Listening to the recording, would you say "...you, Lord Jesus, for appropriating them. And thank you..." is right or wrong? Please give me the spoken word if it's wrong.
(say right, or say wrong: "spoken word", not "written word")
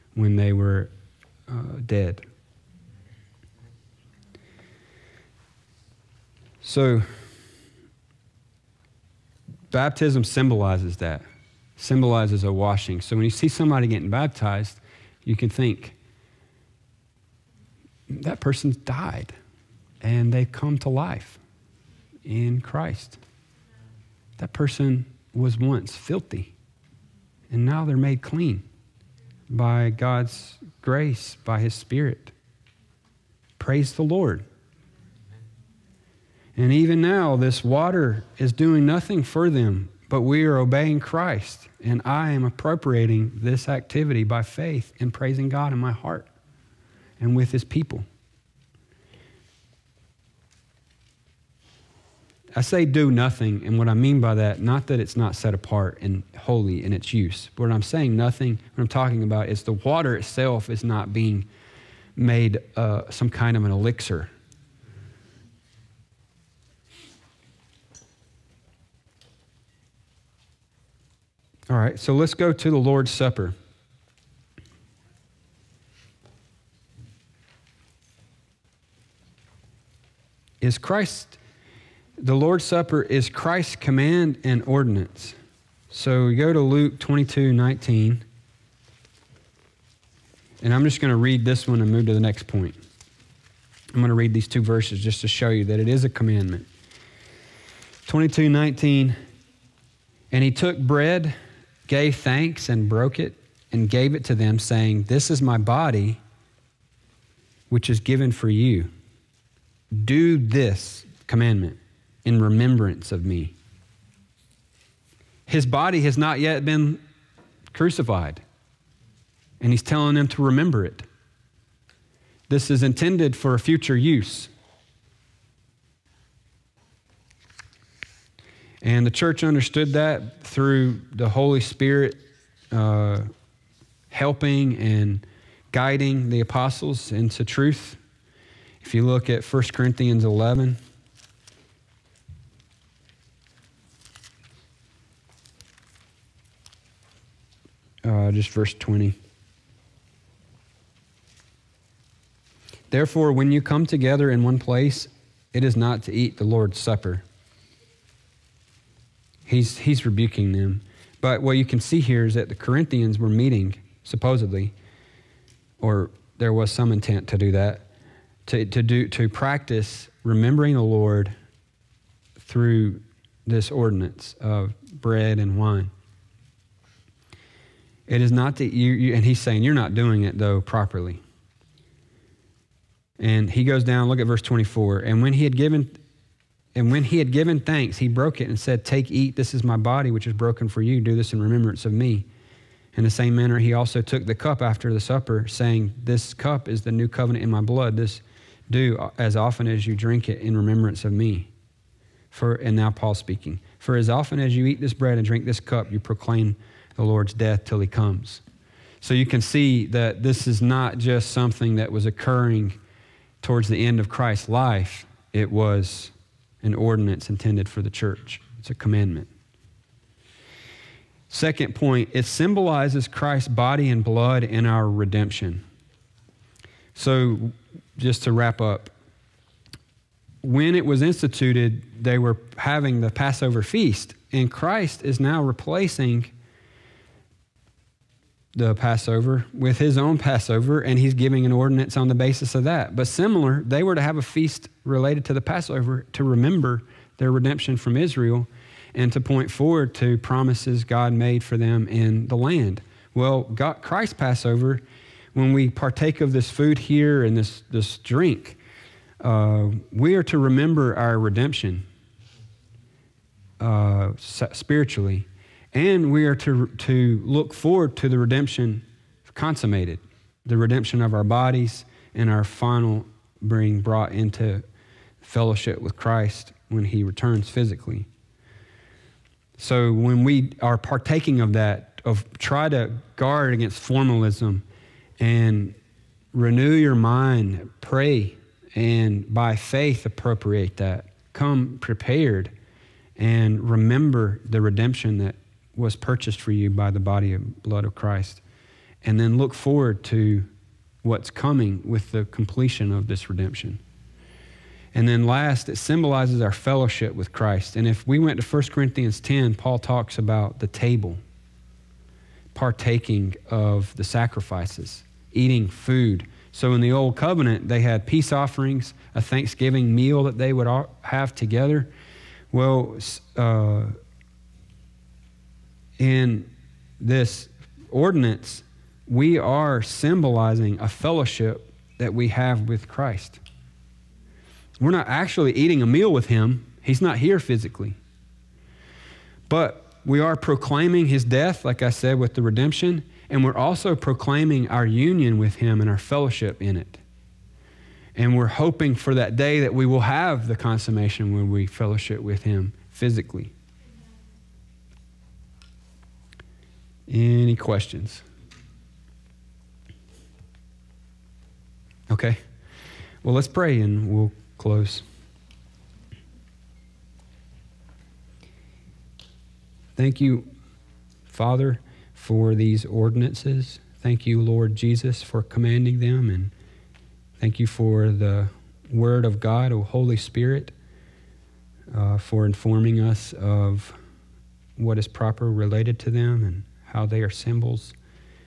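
wrong: "commanding", not "appropriating".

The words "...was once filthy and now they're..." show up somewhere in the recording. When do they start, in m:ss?
0:25.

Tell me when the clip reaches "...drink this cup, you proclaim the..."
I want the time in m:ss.
3:25.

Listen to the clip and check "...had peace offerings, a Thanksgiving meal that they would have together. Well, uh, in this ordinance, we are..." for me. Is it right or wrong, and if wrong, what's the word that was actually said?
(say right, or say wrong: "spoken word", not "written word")
right.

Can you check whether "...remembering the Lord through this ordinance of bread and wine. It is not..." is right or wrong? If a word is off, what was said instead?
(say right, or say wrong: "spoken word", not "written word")
right.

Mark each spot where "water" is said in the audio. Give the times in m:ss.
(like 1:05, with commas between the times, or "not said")
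0:37, 0:59.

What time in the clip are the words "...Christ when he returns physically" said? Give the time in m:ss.
4:35.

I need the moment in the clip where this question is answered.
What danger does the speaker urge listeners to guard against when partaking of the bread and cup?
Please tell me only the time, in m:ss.
4:43.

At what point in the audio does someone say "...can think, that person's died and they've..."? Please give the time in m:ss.
0:15.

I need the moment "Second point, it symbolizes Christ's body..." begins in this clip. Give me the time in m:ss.
3:41.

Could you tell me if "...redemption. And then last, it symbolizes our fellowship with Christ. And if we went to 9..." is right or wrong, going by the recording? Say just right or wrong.
wrong.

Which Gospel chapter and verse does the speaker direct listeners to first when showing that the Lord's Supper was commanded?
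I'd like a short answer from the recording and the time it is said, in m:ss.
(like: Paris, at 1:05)
Luke 22:19, at 1:26.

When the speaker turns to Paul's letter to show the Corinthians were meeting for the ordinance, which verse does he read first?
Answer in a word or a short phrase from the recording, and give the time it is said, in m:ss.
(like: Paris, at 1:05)
1 Corinthians 11:20, at 2:28.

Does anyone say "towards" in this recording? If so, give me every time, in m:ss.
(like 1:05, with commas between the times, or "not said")
3:33.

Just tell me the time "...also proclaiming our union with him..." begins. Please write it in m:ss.
5:43.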